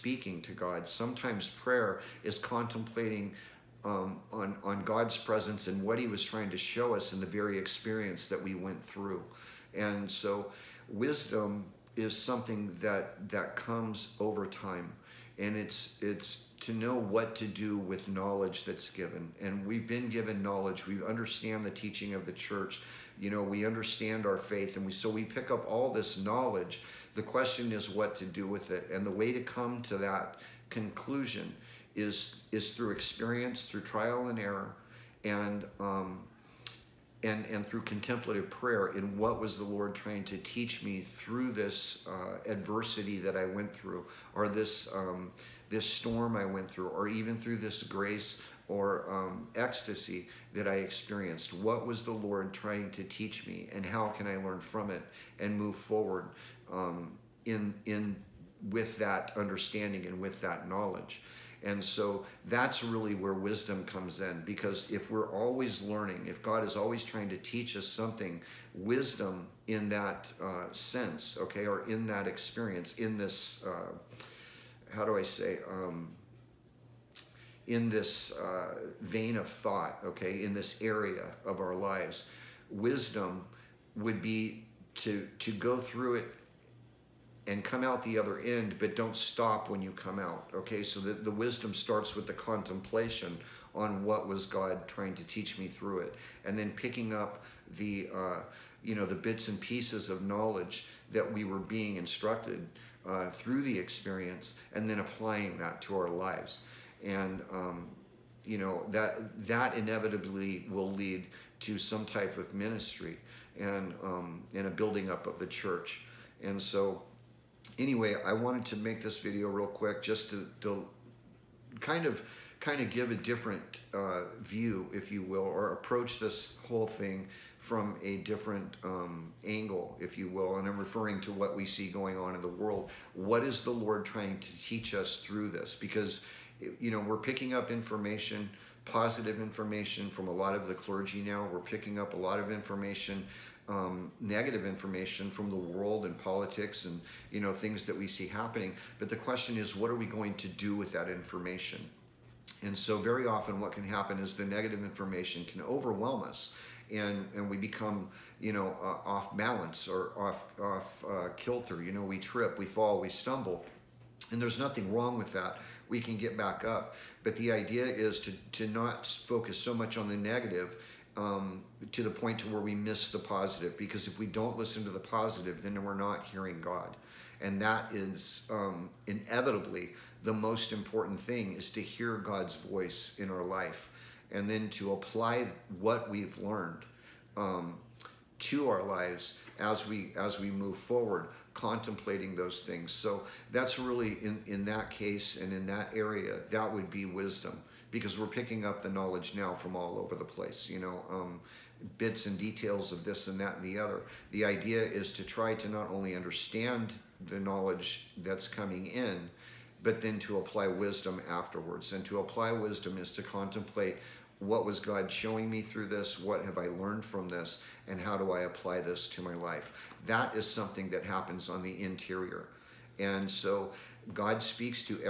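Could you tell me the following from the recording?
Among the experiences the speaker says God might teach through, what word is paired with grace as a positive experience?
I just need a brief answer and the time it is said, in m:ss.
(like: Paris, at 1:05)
Ecstasy, at 0:49.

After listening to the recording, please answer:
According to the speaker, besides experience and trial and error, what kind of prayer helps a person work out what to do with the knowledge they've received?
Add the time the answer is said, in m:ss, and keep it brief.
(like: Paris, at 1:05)
Contemplative prayer, at 0:37.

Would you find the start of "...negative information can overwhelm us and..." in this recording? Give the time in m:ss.
2:34.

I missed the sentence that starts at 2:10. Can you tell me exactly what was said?
And I'm referring to what we see going on in the world.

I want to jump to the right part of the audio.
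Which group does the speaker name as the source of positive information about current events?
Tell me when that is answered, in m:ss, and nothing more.
2:20.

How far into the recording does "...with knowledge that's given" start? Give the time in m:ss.
0:17.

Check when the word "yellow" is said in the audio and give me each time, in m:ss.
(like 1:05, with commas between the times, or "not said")
not said.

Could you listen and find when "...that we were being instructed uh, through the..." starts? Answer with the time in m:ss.
1:41.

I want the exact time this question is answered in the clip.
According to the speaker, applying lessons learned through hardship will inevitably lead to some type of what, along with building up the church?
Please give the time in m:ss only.
1:52.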